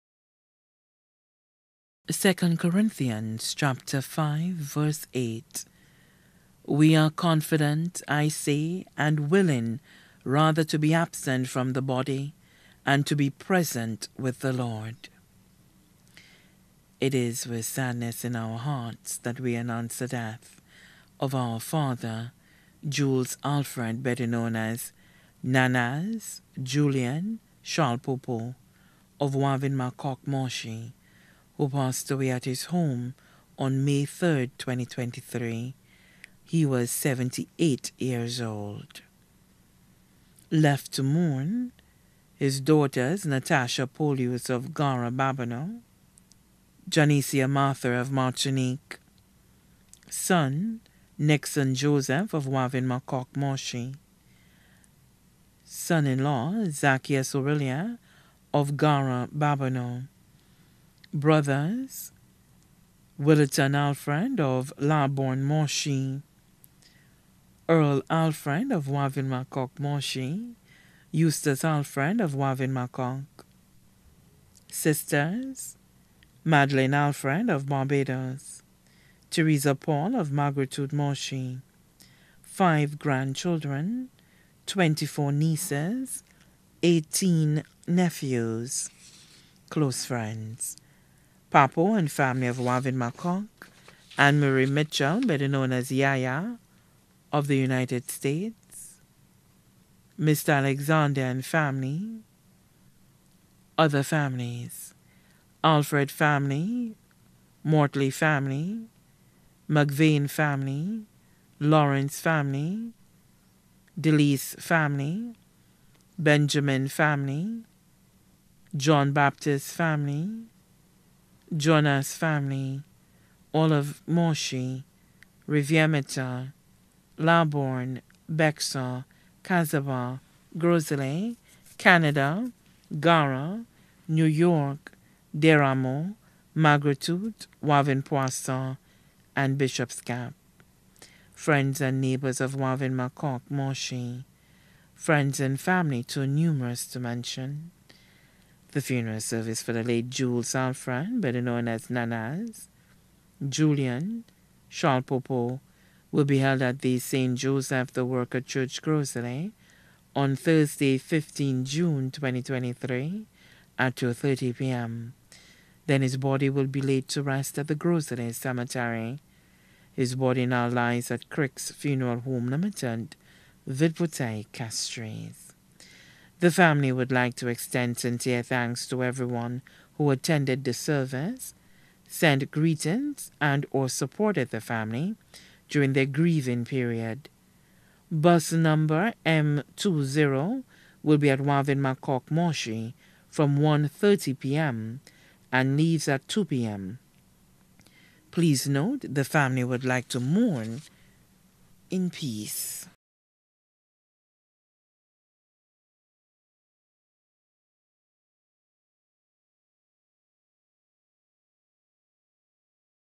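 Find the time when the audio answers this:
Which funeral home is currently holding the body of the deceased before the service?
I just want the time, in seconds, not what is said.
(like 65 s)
171 s.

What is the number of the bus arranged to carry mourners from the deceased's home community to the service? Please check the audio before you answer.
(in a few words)
M20.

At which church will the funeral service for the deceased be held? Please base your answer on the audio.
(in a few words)
St. Joseph the Worker Church.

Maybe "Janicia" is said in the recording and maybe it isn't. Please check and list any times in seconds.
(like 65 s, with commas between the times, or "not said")
46 s.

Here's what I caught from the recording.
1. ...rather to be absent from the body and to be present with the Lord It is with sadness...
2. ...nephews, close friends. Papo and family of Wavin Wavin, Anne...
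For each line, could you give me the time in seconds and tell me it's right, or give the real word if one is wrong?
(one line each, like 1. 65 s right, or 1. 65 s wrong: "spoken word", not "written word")
1. 10 s right
2. 87 s wrong: "McConk", not "Wavin".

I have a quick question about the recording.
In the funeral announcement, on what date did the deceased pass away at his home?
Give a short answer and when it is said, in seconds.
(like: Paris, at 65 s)
May 3, 2023, at 33 s.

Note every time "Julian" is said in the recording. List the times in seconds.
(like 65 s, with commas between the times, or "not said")
26 s, 153 s.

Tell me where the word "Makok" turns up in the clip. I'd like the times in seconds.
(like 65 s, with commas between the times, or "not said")
29 s, 52 s, 191 s.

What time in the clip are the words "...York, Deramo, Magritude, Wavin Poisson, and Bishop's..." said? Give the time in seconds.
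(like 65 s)
134 s.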